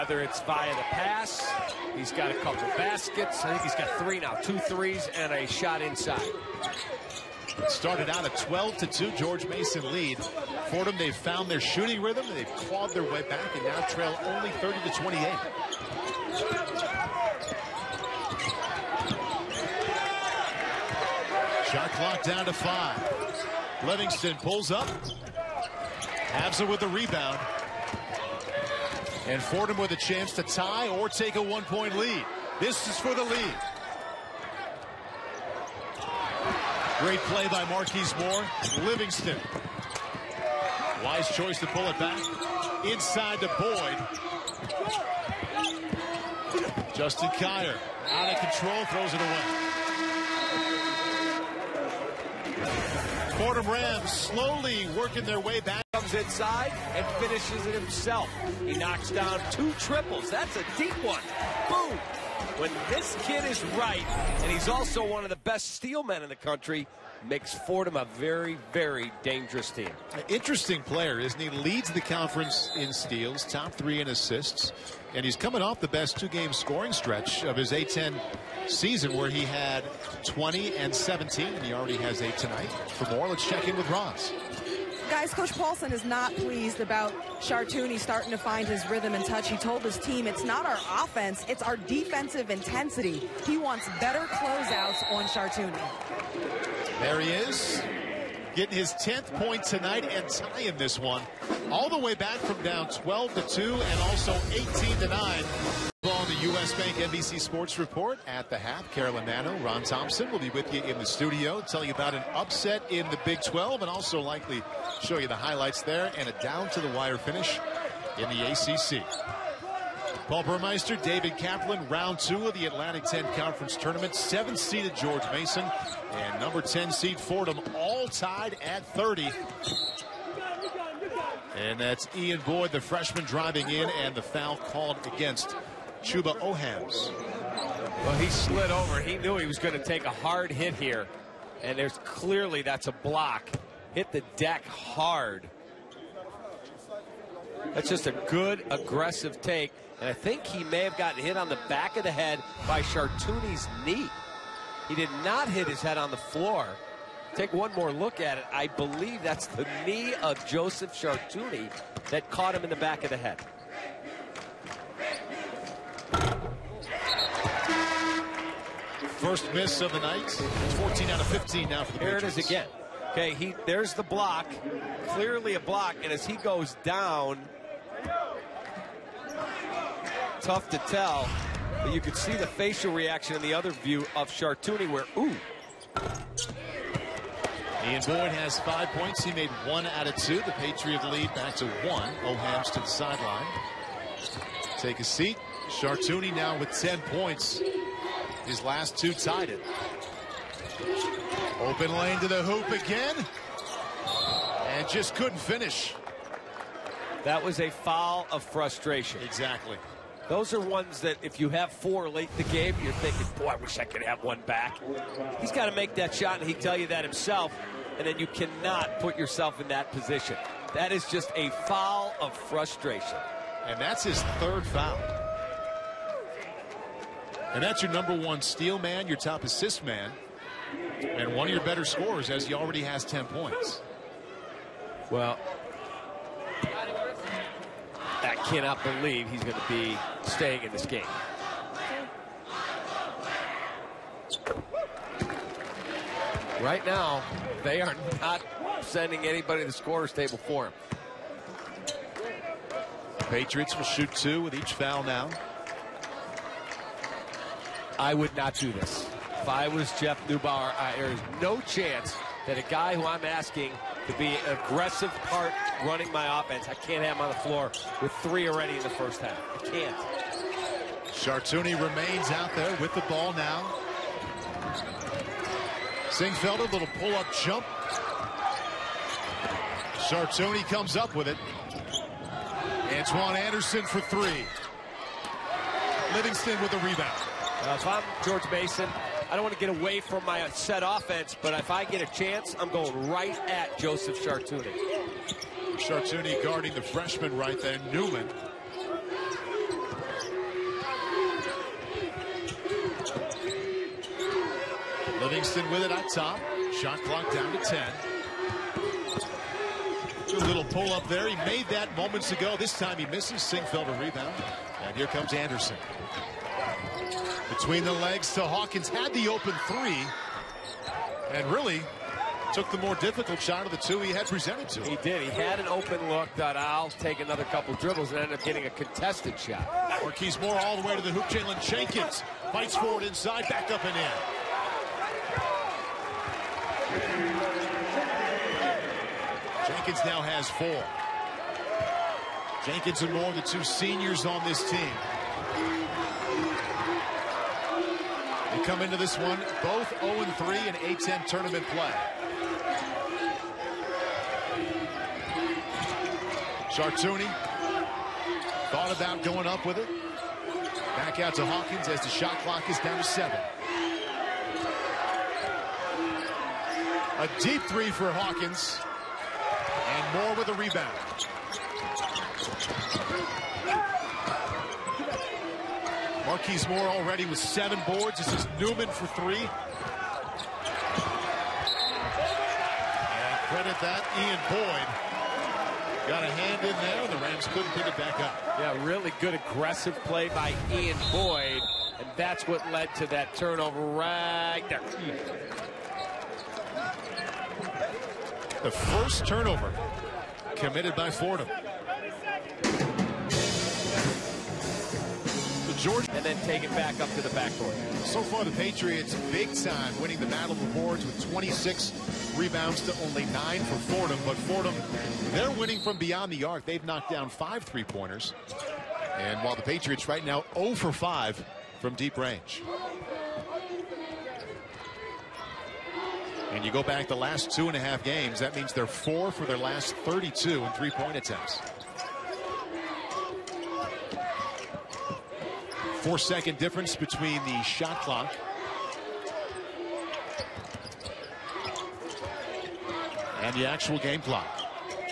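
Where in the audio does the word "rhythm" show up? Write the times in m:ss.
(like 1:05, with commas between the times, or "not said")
0:12, 1:28.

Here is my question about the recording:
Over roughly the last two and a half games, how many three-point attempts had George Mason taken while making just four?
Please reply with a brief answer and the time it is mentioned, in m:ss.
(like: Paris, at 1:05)
32, at 7:09.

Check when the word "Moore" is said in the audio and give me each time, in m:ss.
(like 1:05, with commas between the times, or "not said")
0:38, 5:30, 5:43, 6:10, 6:16.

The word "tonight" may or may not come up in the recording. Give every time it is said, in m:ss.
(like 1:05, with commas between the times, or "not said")
1:22, 1:39.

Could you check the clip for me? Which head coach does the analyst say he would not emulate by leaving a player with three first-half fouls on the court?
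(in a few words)
Jeff Neubauer.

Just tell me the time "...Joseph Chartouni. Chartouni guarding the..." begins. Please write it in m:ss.
4:53.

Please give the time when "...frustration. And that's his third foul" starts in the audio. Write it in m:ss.
3:42.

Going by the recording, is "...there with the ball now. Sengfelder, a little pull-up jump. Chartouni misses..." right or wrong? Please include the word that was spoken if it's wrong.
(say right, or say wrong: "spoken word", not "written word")
wrong: "comes", not "misses".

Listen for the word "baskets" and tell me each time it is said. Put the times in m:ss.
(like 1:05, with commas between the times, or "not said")
0:02.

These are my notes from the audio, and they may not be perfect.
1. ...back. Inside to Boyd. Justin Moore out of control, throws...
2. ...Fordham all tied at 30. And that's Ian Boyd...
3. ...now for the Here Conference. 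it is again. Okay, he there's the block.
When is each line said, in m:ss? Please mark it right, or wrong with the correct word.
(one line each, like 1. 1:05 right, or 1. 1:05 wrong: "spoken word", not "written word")
1. 0:41 wrong: "Kier", not "Moore"
2. 2:07 right
3. 2:51 wrong: "Patriots", not "Conference".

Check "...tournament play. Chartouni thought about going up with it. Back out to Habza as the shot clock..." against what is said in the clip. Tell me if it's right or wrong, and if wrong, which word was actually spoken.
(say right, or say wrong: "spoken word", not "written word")
wrong: "Hawkins", not "Habza".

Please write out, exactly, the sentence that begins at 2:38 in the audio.
I believe that's the knee of Joseph Chartouni that caught him in the back of the head.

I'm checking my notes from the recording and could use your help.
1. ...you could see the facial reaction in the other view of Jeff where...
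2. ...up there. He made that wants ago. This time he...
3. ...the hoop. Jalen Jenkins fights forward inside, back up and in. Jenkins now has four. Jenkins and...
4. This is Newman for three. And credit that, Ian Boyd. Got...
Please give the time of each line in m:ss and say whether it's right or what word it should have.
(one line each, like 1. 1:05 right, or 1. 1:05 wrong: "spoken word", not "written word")
1. 3:01 wrong: "Chartouni", not "Jeff"
2. 5:10 wrong: "moments", not "wants"
3. 5:31 right
4. 6:18 right.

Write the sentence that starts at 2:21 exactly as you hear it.
And there's clearly that's a block.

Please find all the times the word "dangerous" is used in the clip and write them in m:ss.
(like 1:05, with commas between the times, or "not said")
1:09.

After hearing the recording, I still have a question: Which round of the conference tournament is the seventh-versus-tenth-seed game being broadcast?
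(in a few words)
Round two.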